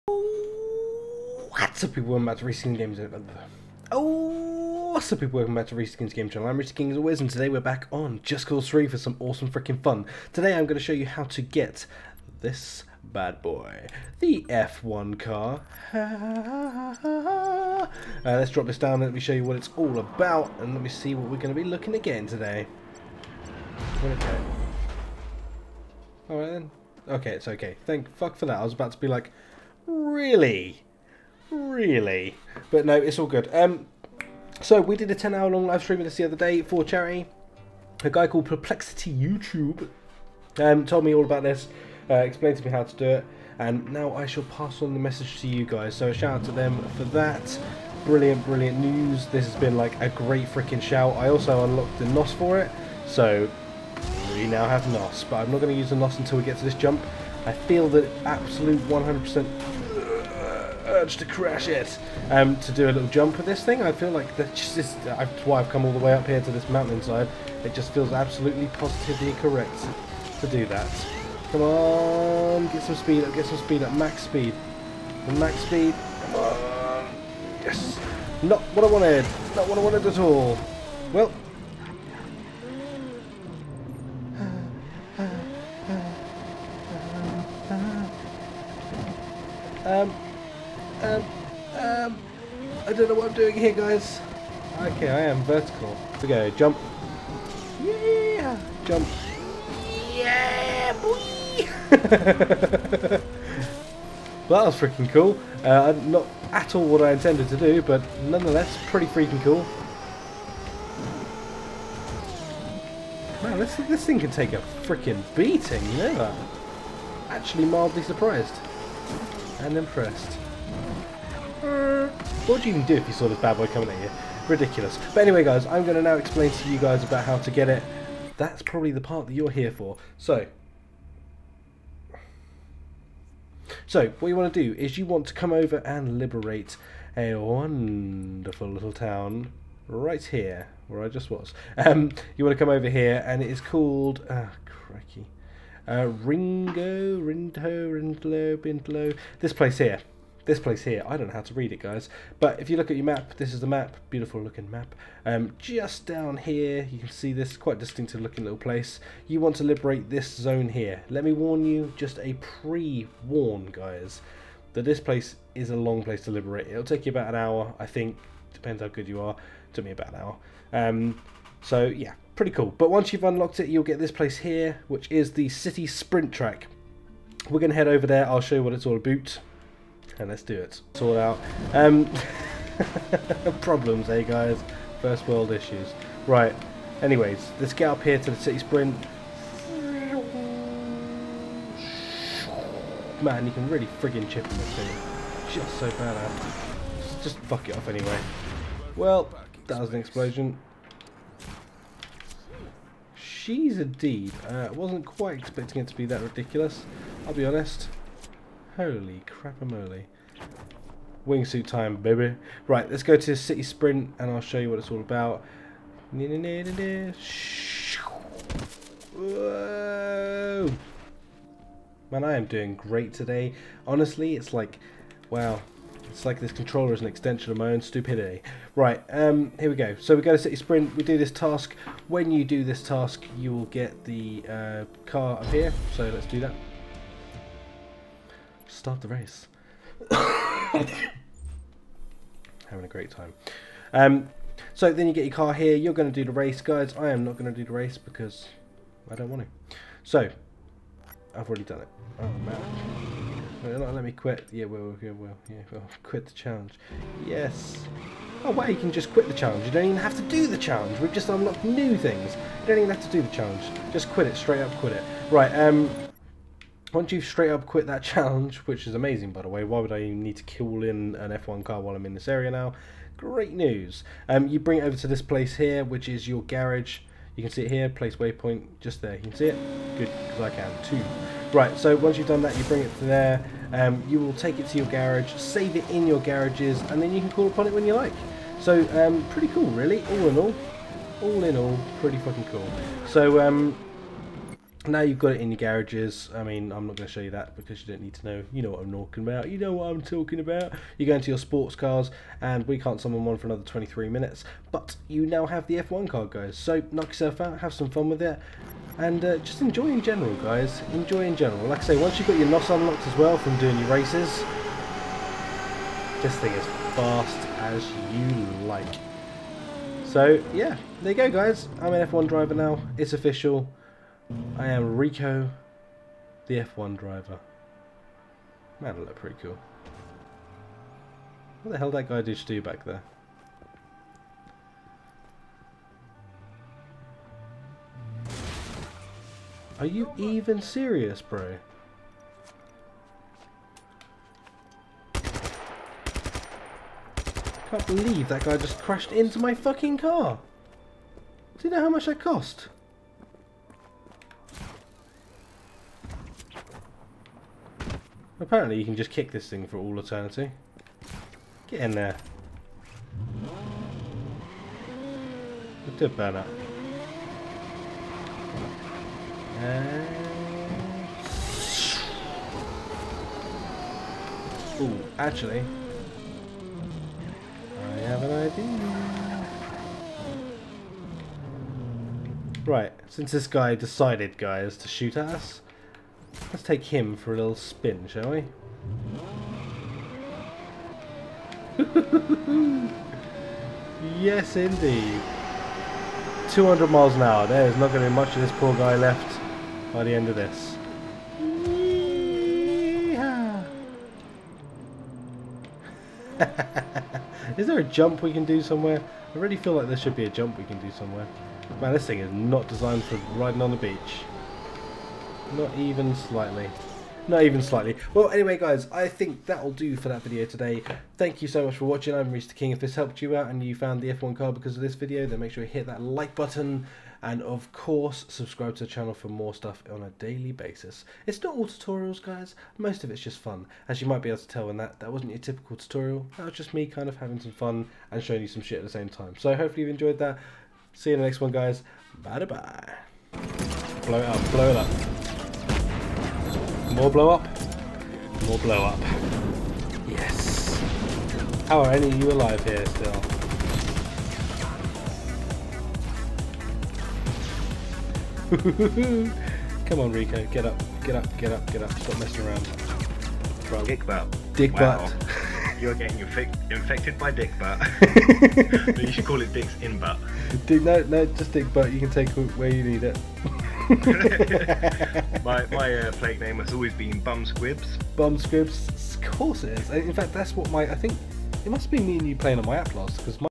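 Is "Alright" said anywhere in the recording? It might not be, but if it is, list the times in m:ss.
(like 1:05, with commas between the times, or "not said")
0:26.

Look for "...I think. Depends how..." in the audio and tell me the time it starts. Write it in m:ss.
2:47.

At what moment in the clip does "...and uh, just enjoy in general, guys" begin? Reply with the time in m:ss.
5:08.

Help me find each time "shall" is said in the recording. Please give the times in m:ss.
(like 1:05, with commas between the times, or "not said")
0:44, 6:28.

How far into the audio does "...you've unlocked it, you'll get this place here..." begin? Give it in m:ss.
2:53.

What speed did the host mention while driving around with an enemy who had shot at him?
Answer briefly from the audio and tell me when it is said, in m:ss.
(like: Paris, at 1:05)
200 miles an hour, at 6:36.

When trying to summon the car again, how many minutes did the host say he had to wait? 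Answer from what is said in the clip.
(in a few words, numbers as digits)
23 minutes.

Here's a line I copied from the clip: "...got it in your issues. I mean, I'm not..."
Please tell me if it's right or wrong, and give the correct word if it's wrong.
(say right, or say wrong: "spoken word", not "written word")
wrong: "garages", not "issues".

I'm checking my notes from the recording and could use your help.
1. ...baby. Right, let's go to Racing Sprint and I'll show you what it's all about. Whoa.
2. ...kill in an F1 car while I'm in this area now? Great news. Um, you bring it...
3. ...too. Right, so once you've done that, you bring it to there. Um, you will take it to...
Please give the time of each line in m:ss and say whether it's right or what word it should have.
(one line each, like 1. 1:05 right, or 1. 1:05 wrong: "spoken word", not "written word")
1. 3:31 wrong: "City", not "Racing"
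2. 4:30 right
3. 4:40 right.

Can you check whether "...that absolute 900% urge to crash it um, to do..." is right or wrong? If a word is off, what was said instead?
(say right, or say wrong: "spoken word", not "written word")
wrong: "100", not "900".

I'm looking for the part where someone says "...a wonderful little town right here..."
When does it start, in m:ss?
2:17.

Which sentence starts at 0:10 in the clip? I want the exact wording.
Today I'm going to show you how to get this bad boy, the F1 car.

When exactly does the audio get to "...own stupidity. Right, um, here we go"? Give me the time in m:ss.
3:47.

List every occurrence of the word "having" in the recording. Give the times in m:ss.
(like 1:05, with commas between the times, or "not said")
4:00, 7:17.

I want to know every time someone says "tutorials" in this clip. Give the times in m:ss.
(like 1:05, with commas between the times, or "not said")
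7:11, 7:15.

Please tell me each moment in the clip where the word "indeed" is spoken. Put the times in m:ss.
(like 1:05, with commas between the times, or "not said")
6:34.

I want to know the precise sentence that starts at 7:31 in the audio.
How are any of you alive here still?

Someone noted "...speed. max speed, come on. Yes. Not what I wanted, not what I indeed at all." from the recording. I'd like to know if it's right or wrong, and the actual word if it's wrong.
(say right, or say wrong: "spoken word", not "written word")
wrong: "wanted", not "indeed".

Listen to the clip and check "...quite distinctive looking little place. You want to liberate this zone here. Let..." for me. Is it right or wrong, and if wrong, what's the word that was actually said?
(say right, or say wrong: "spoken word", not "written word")
right.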